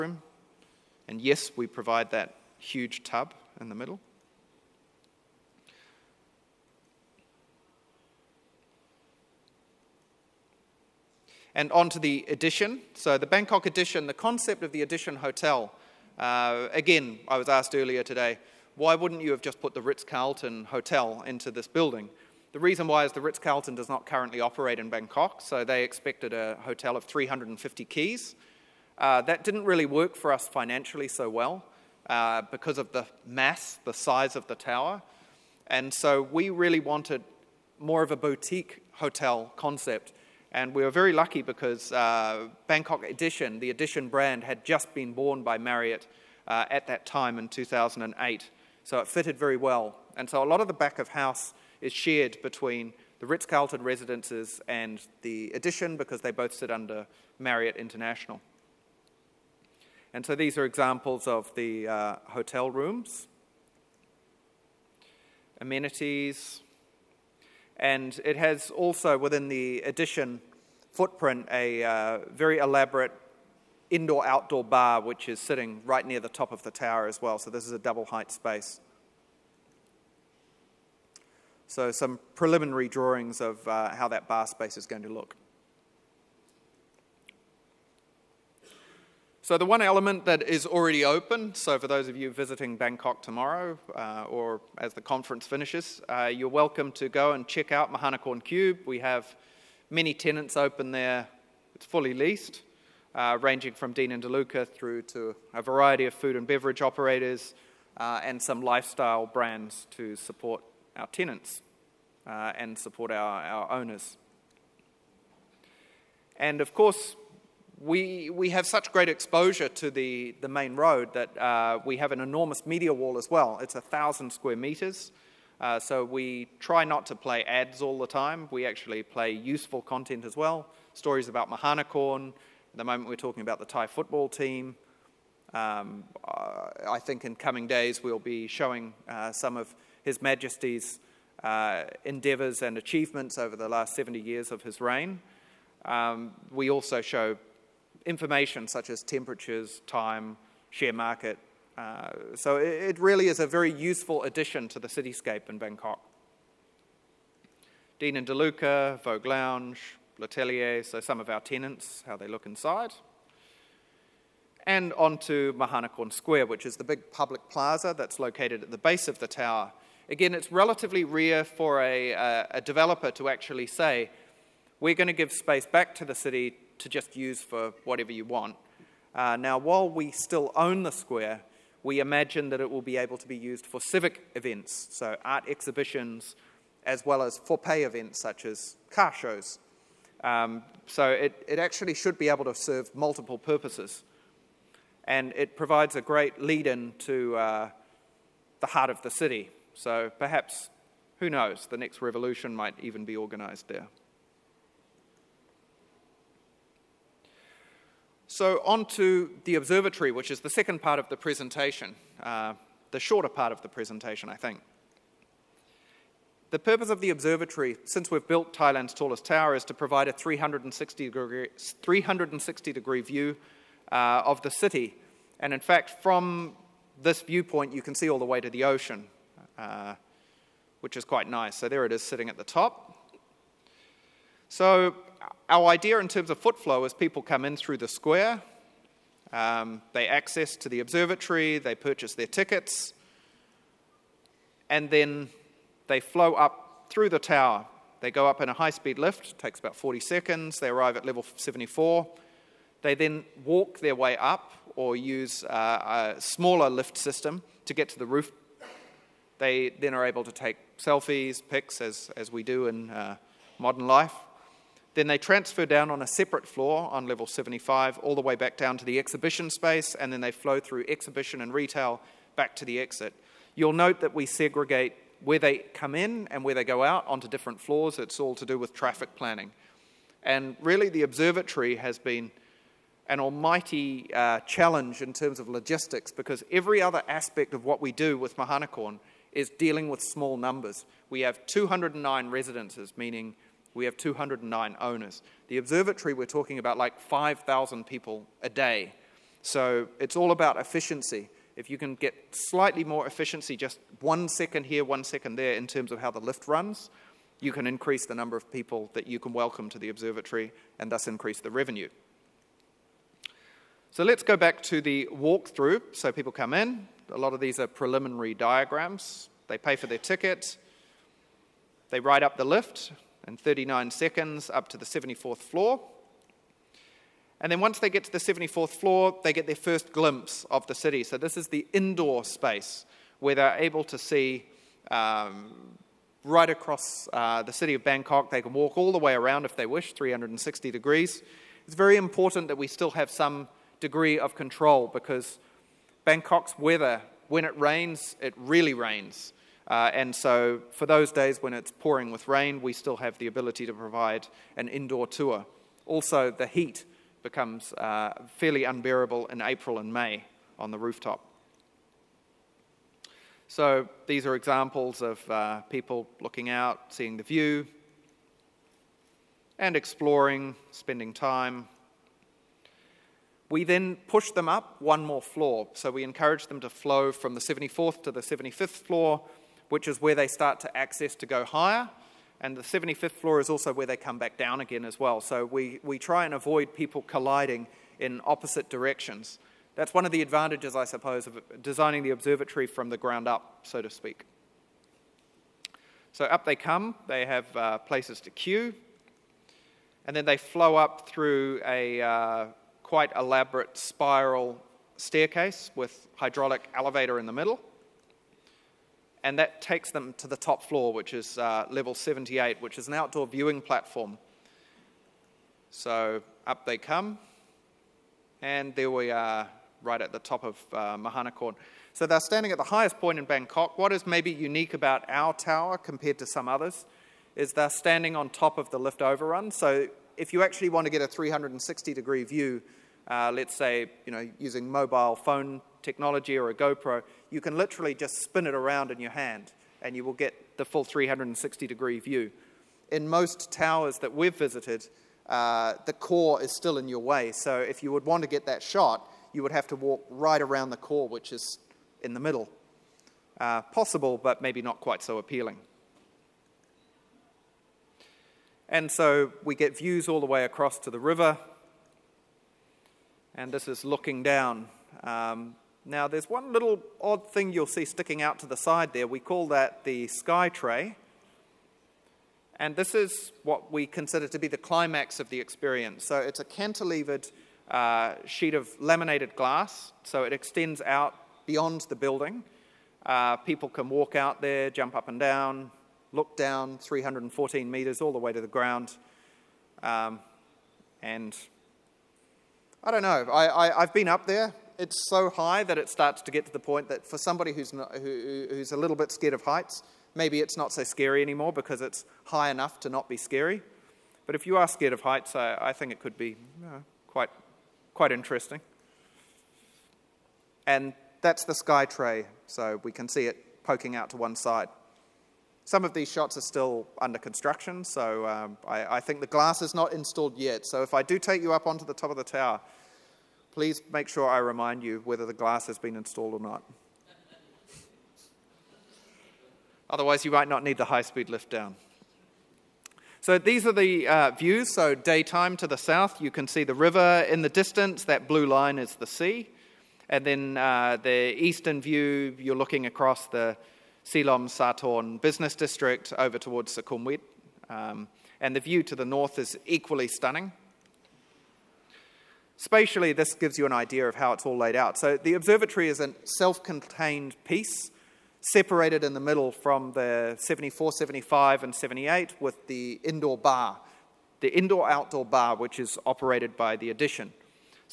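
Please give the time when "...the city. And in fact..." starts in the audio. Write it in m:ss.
3:44.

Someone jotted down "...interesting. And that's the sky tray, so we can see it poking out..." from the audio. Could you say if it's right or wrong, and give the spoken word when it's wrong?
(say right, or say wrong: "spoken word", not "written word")
right.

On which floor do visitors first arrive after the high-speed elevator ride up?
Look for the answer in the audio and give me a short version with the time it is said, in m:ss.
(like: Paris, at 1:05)
Level 74, at 4:11.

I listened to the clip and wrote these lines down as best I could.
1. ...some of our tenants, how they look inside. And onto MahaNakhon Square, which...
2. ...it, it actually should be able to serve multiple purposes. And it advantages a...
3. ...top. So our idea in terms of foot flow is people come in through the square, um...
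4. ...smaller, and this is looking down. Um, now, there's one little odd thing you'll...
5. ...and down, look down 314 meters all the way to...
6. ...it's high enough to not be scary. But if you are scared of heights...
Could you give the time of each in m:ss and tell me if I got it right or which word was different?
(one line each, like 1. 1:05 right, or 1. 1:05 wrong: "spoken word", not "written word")
1. 2:40 right
2. 3:11 wrong: "provides", not "advantages"
3. 3:52 right
4. 7:40 wrong: "river", not "smaller"
5. 8:05 right
6. 8:21 right.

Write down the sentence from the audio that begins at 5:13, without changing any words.
So let's go back to the walkthrough.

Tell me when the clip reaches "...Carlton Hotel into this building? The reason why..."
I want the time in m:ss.
0:20.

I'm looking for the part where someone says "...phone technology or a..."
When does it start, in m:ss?
7:15.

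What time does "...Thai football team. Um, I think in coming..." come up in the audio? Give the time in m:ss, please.
2:13.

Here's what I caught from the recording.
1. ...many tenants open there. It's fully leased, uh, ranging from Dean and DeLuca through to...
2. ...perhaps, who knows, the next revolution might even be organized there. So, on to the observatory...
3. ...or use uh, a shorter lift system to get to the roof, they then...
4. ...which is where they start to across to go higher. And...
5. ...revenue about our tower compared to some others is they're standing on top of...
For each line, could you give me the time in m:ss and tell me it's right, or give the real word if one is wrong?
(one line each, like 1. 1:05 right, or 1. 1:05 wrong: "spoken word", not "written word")
1. 1:39 right
2. 3:20 right
3. 4:14 wrong: "smaller", not "shorter"
4. 6:19 wrong: "access", not "across"
5. 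7:04 wrong: "unique", not "revenue".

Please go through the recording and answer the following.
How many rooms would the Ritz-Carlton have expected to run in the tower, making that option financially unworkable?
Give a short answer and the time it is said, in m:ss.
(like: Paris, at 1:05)
350, at 0:27.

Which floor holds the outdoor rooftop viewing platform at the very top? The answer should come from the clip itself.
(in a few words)
Level 78.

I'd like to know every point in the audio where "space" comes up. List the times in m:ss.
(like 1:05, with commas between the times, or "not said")
1:18, 1:24, 2:55, 4:29, 5:32.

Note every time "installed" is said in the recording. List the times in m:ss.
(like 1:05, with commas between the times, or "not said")
8:39, 8:45.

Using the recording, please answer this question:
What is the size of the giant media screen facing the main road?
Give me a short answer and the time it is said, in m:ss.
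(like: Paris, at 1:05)
1,000 square meters, at 2:03.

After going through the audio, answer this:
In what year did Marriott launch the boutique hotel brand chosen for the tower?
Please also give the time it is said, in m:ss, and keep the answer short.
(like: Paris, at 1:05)
2008, at 0:47.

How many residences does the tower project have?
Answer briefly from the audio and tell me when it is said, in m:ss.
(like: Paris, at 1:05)
209, at 4:51.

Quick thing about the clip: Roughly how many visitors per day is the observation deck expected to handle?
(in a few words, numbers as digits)
5,000.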